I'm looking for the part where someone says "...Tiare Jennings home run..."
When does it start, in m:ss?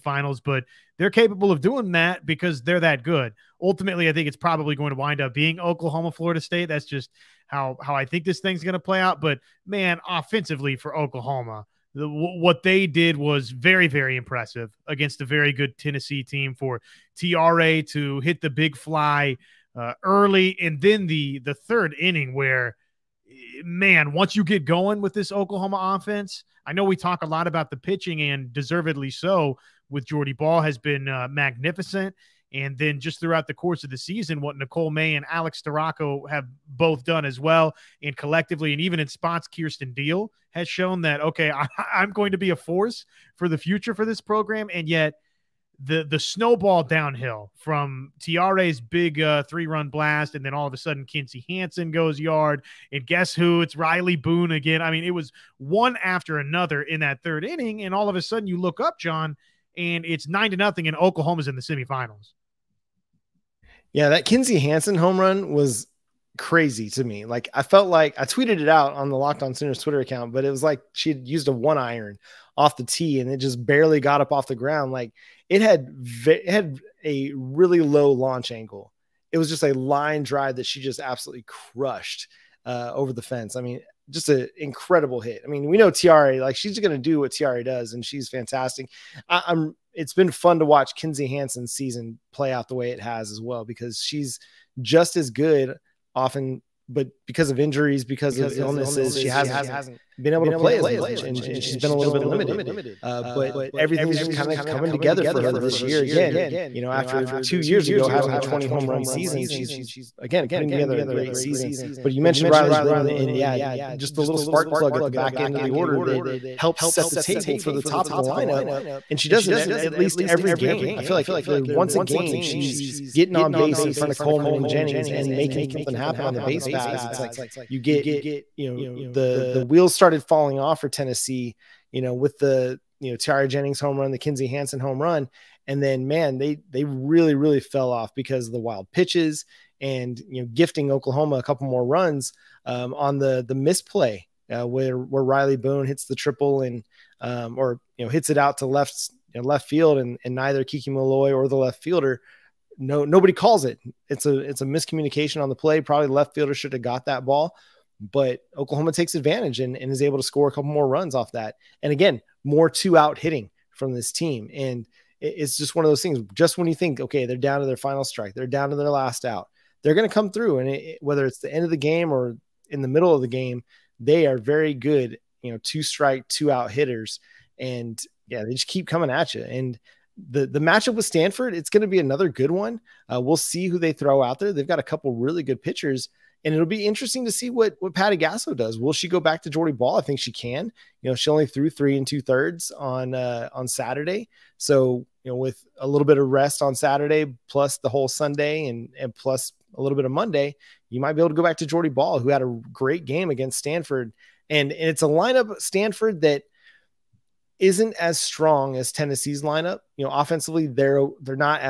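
2:13.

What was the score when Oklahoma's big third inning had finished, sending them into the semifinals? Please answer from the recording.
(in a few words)
9-0.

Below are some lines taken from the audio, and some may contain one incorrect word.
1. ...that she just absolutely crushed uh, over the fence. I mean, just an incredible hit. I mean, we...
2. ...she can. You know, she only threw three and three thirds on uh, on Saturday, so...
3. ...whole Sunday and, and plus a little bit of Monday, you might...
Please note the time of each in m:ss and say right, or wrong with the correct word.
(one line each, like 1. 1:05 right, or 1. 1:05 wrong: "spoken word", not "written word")
1. 1:20 right
2. 3:10 wrong: "two", not "three"
3. 3:17 right.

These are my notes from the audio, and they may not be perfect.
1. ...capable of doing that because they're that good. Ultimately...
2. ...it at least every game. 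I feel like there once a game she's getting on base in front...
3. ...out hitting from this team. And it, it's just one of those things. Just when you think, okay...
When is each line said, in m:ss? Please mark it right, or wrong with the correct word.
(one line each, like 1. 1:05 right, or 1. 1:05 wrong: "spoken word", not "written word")
1. 0:01 right
2. 1:59 right
3. 2:42 right.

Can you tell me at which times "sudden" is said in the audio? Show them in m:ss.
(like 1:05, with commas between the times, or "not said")
0:50, 0:58.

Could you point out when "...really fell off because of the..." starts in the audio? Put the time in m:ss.
2:17.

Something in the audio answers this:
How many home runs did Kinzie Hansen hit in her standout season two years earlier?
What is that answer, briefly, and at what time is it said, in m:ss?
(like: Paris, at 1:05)
20, at 1:48.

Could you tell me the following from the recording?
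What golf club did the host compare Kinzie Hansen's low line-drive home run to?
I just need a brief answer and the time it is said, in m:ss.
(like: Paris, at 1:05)
One iron, at 1:11.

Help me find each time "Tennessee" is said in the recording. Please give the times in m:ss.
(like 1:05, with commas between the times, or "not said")
0:15, 2:10, 3:28.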